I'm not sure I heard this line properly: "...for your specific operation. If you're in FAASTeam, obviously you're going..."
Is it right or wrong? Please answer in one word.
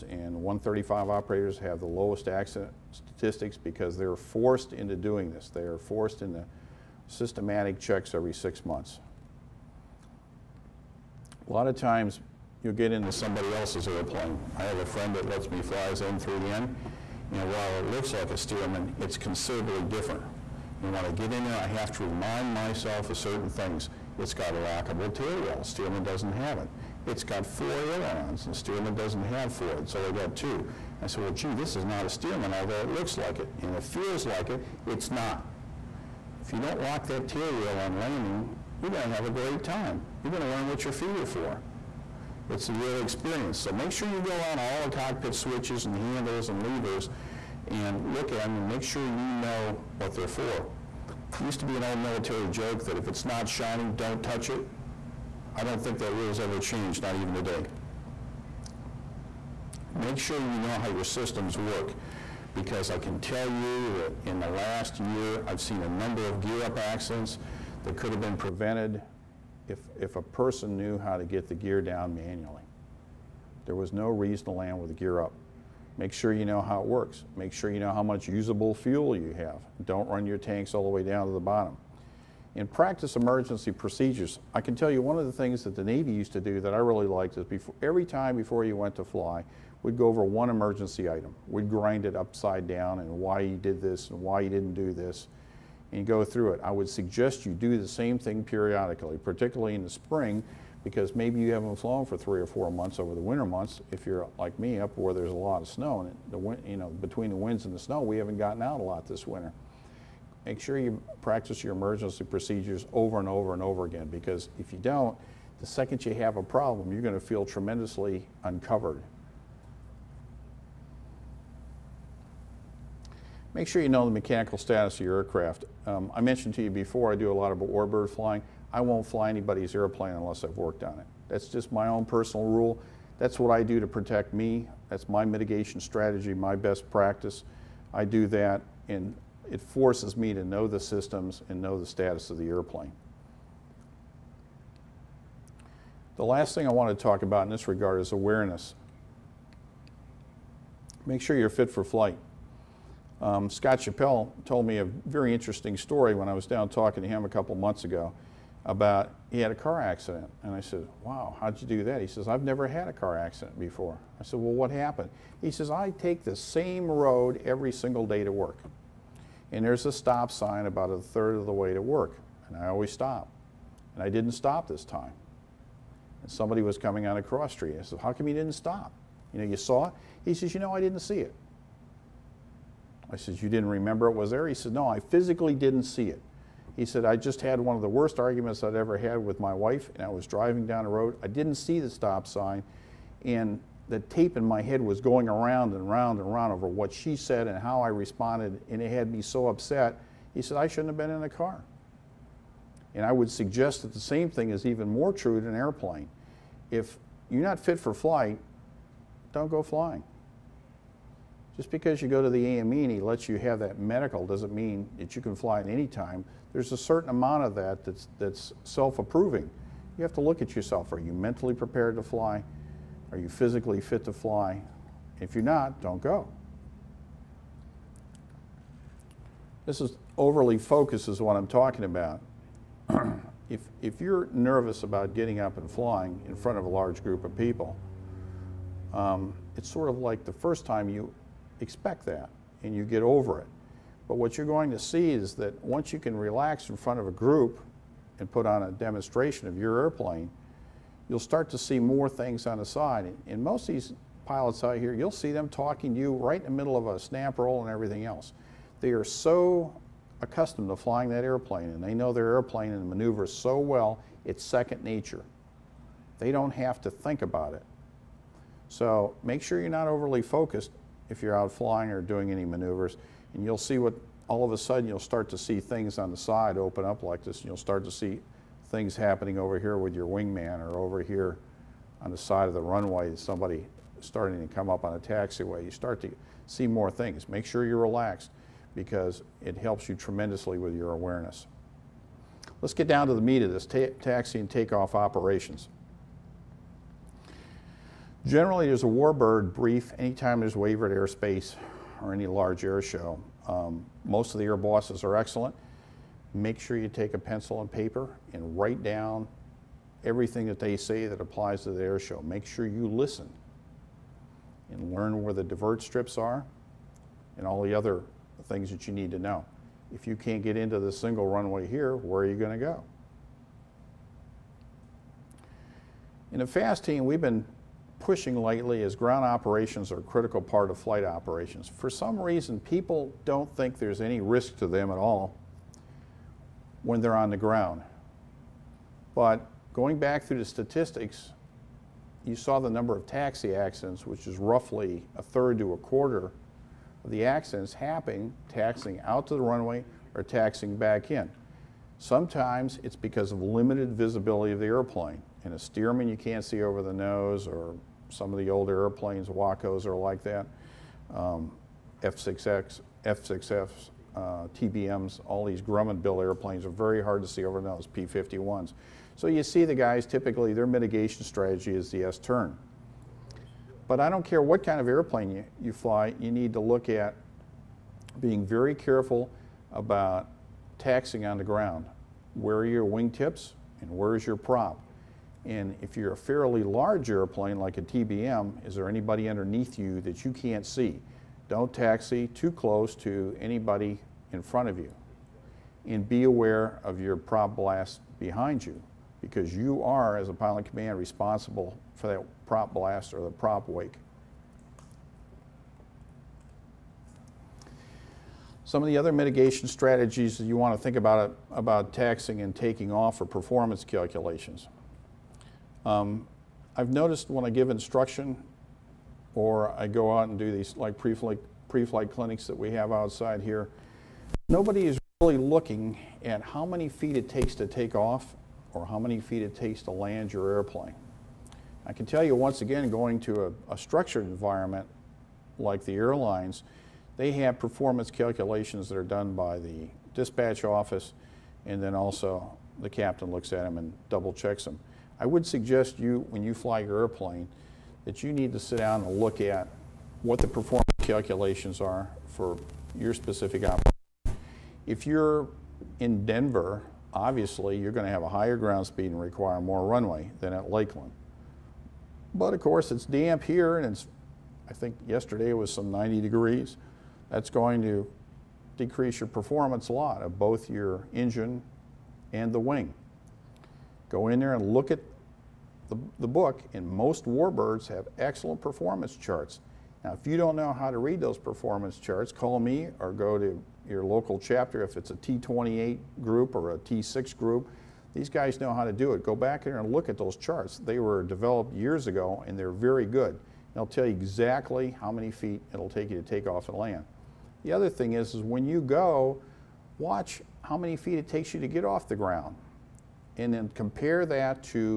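wrong.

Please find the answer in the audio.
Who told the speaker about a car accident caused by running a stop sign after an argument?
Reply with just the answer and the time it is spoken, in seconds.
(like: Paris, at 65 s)
Scott Chappell, at 153 s.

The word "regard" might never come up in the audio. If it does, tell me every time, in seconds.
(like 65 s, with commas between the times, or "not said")
147 s.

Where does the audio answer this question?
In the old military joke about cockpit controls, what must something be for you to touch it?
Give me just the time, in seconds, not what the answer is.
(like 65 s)
53 s.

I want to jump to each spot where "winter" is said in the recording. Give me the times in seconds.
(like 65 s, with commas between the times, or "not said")
103 s, 109 s.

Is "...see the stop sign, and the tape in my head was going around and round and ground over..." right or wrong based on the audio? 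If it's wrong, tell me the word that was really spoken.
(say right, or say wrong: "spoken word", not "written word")
wrong: "round", not "ground".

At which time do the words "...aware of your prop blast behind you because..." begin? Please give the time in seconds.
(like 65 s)
396 s.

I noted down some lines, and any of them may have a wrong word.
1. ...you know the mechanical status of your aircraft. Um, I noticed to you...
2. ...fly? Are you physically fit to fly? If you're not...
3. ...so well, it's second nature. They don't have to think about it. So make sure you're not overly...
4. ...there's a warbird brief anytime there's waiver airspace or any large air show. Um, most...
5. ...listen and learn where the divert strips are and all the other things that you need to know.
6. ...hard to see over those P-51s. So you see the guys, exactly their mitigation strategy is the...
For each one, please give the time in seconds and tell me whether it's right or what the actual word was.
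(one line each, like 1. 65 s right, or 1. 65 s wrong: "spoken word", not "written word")
1. 123 s wrong: "mentioned", not "noticed"
2. 222 s right
3. 263 s right
4. 298 s right
5. 312 s right
6. 367 s wrong: "typically", not "exactly".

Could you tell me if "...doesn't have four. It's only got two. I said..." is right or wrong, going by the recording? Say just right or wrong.
right.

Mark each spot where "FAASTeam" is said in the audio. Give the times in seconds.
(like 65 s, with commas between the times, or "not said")
326 s.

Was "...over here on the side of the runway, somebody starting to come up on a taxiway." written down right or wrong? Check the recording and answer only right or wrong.
right.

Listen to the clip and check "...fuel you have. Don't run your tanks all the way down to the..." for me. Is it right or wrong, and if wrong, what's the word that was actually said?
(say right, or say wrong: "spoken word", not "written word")
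right.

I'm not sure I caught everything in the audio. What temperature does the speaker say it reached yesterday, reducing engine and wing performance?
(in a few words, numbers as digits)
90 degrees.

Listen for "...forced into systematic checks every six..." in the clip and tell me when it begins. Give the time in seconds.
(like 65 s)
5 s.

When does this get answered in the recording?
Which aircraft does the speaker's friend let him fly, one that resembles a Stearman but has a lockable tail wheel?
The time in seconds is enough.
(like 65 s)
16 s.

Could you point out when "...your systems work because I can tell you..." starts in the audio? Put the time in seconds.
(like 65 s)
60 s.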